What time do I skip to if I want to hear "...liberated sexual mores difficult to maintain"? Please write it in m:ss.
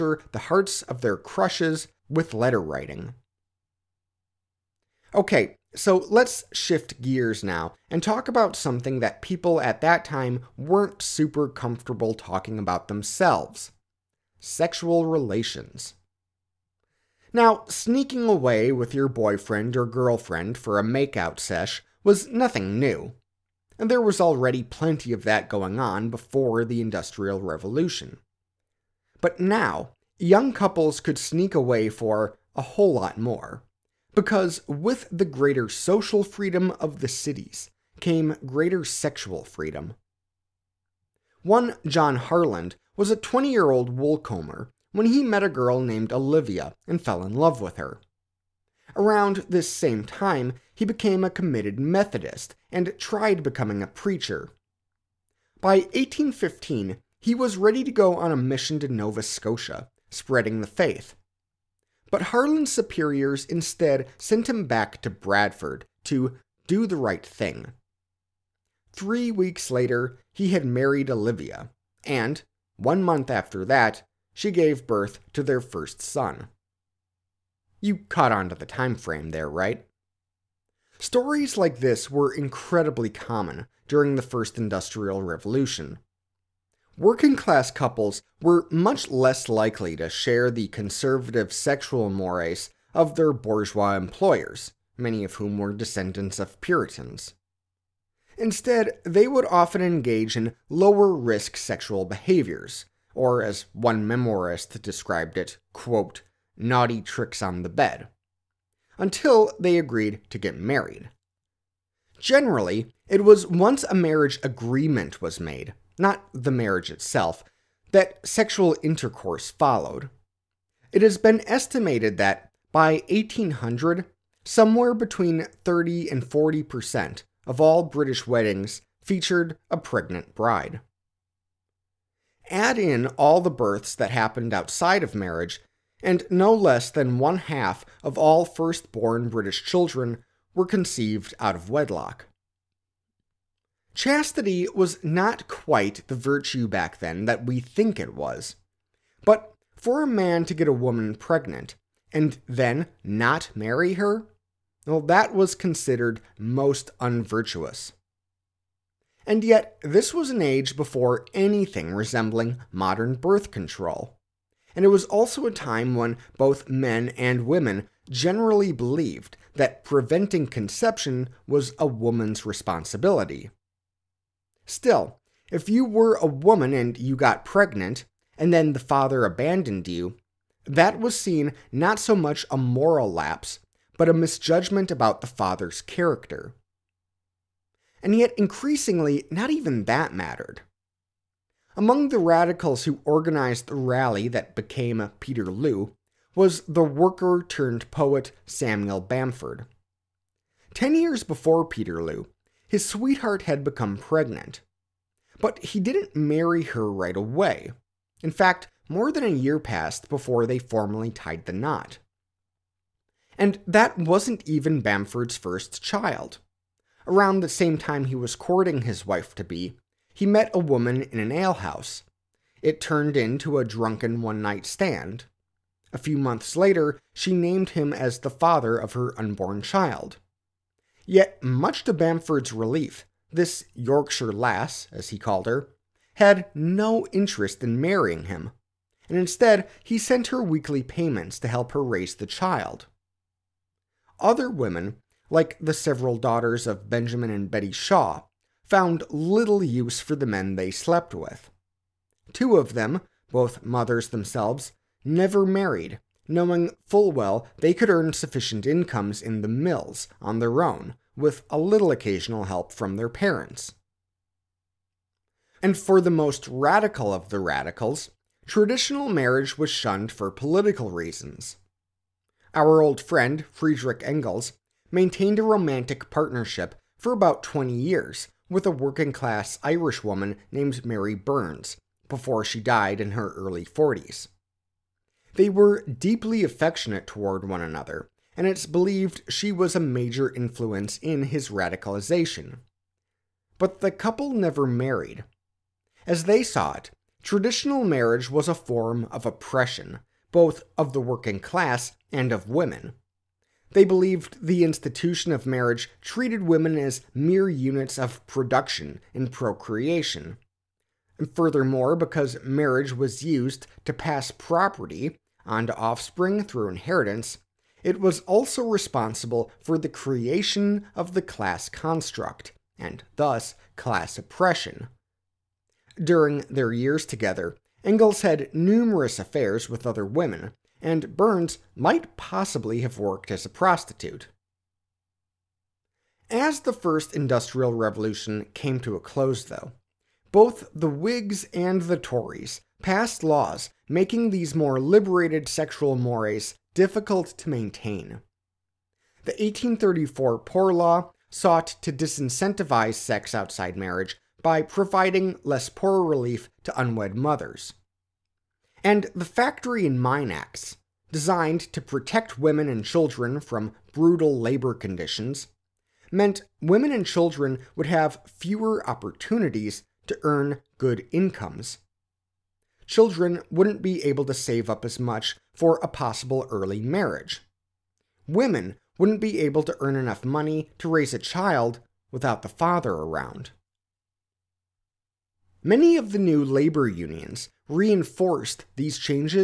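5:44.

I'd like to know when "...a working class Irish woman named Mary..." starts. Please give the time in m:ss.
4:38.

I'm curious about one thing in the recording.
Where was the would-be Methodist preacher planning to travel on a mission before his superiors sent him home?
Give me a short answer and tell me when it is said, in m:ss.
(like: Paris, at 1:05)
Nova Scotia, at 0:58.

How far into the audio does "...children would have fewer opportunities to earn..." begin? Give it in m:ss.
6:07.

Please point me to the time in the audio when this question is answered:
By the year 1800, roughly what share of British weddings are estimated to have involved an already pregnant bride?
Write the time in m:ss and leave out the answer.
2:04.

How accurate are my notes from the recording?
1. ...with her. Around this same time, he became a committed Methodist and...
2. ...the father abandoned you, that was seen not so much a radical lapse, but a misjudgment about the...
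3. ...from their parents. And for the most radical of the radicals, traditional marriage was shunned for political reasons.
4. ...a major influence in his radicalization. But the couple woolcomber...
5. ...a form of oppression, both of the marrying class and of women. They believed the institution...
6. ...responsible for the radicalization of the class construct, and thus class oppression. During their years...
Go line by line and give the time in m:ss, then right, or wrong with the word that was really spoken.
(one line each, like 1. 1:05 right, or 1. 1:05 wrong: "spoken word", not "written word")
1. 0:47 right
2. 2:58 wrong: "moral", not "radical"
3. 4:22 right
4. 4:49 wrong: "never", not "woolcomber"
5. 4:58 wrong: "working", not "marrying"
6. 5:18 wrong: "creation", not "radicalization".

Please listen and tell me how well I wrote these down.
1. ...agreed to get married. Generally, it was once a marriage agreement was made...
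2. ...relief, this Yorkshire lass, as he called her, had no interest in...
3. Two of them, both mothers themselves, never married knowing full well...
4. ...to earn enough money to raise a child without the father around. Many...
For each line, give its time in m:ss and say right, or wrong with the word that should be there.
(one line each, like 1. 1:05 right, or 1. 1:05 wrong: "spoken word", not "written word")
1. 1:49 right
2. 3:52 right
3. 4:12 right
4. 6:19 right.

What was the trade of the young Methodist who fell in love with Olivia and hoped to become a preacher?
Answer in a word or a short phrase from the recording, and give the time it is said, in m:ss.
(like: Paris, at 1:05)
woolcomber, at 0:43.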